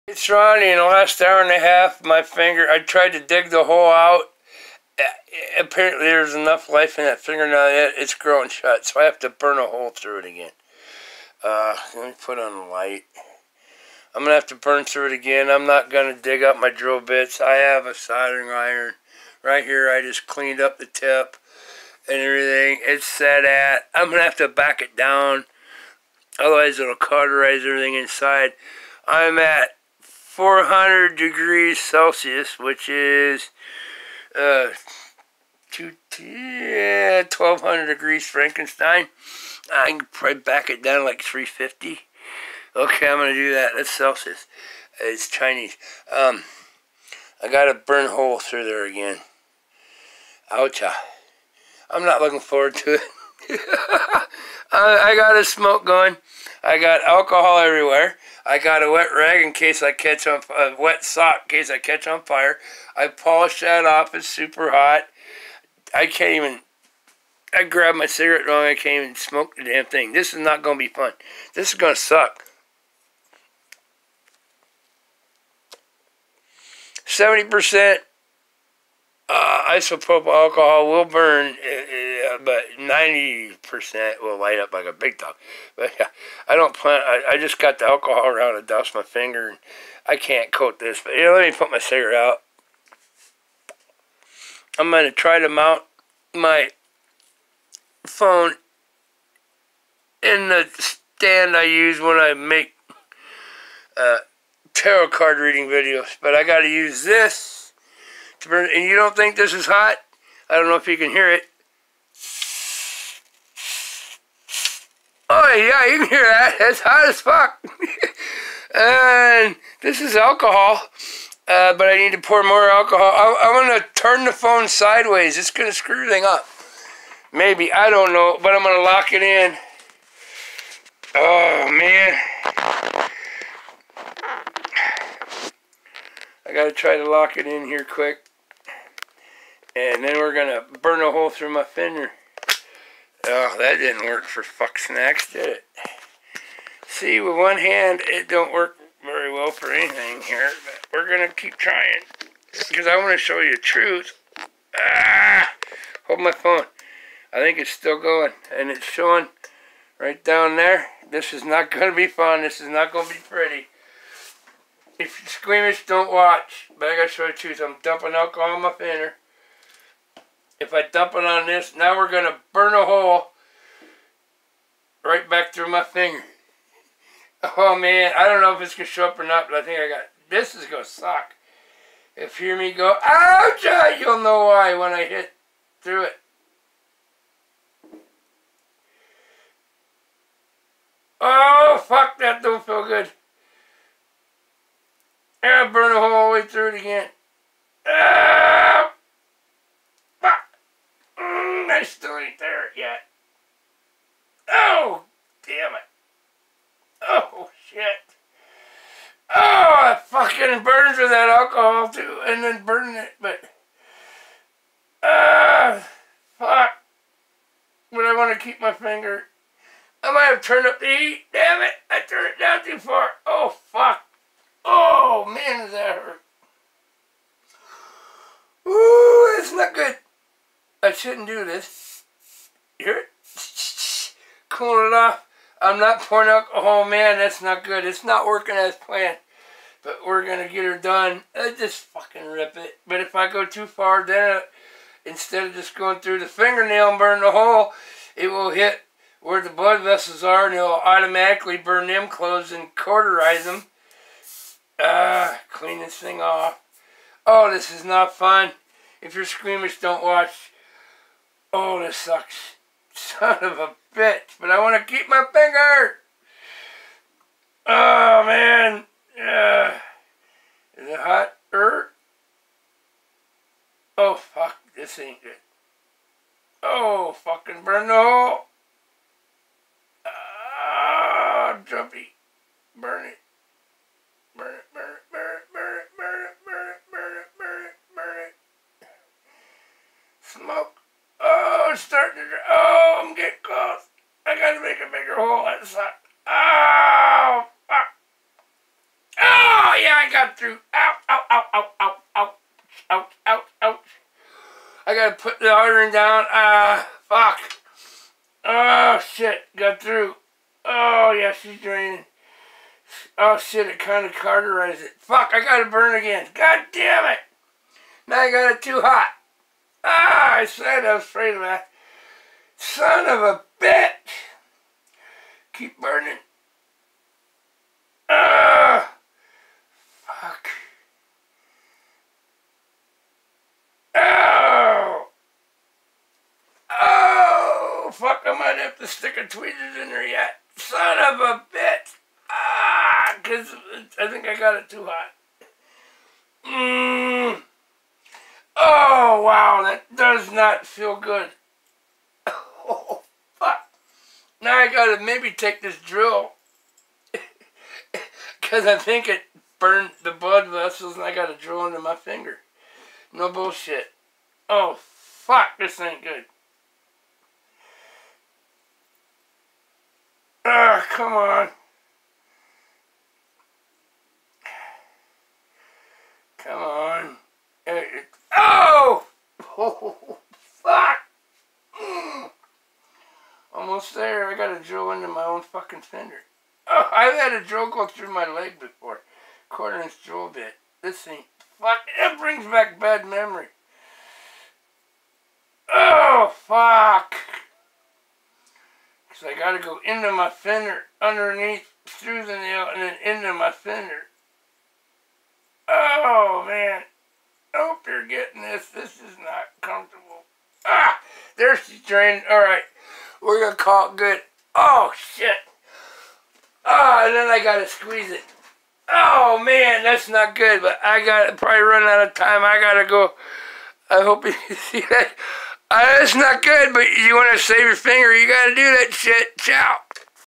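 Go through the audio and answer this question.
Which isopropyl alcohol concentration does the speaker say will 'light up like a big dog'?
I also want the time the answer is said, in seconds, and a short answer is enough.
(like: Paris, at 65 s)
90%, at 82 s.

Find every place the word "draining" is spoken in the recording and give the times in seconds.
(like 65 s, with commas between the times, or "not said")
311 s, 411 s.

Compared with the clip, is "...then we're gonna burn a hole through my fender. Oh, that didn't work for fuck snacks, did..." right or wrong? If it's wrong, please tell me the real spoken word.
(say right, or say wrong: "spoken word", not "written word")
right.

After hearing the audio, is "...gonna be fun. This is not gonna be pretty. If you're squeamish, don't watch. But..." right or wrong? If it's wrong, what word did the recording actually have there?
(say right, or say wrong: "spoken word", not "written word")
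right.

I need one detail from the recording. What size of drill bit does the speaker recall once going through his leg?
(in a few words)
Quarter inch.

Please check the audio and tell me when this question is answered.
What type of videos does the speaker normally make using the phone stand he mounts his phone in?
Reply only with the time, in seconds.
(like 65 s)
104 s.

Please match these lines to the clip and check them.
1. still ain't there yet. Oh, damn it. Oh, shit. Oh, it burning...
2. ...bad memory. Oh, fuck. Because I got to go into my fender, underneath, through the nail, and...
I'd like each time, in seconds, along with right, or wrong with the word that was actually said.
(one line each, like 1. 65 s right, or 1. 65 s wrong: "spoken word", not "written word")
1. 202 s wrong: "fucking", not "burning"
2. 392 s right.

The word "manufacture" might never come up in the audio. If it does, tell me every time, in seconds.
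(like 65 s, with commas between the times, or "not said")
not said.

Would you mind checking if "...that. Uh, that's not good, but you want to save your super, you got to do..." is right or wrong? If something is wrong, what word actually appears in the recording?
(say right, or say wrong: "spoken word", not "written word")
wrong: "finger", not "super".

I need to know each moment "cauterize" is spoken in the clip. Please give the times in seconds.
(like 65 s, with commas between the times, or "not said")
26 s, 252 s.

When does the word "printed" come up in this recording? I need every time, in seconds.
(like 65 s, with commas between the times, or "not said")
not said.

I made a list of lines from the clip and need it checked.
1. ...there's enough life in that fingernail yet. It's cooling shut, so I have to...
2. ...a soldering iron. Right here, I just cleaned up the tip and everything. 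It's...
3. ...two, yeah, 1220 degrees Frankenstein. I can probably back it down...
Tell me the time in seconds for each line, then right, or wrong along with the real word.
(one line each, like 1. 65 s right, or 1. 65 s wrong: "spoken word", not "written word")
1. 6 s wrong: "growing", not "cooling"
2. 17 s right
3. 35 s wrong: "1200", not "1220".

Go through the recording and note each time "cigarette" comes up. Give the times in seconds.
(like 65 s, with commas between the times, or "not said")
68 s, 91 s.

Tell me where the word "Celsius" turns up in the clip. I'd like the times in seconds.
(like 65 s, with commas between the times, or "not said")
31 s, 43 s.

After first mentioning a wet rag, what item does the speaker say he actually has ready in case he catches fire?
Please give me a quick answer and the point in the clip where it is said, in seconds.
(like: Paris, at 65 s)
A wet sock, at 60 s.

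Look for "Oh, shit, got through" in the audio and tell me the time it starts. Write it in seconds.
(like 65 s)
308 s.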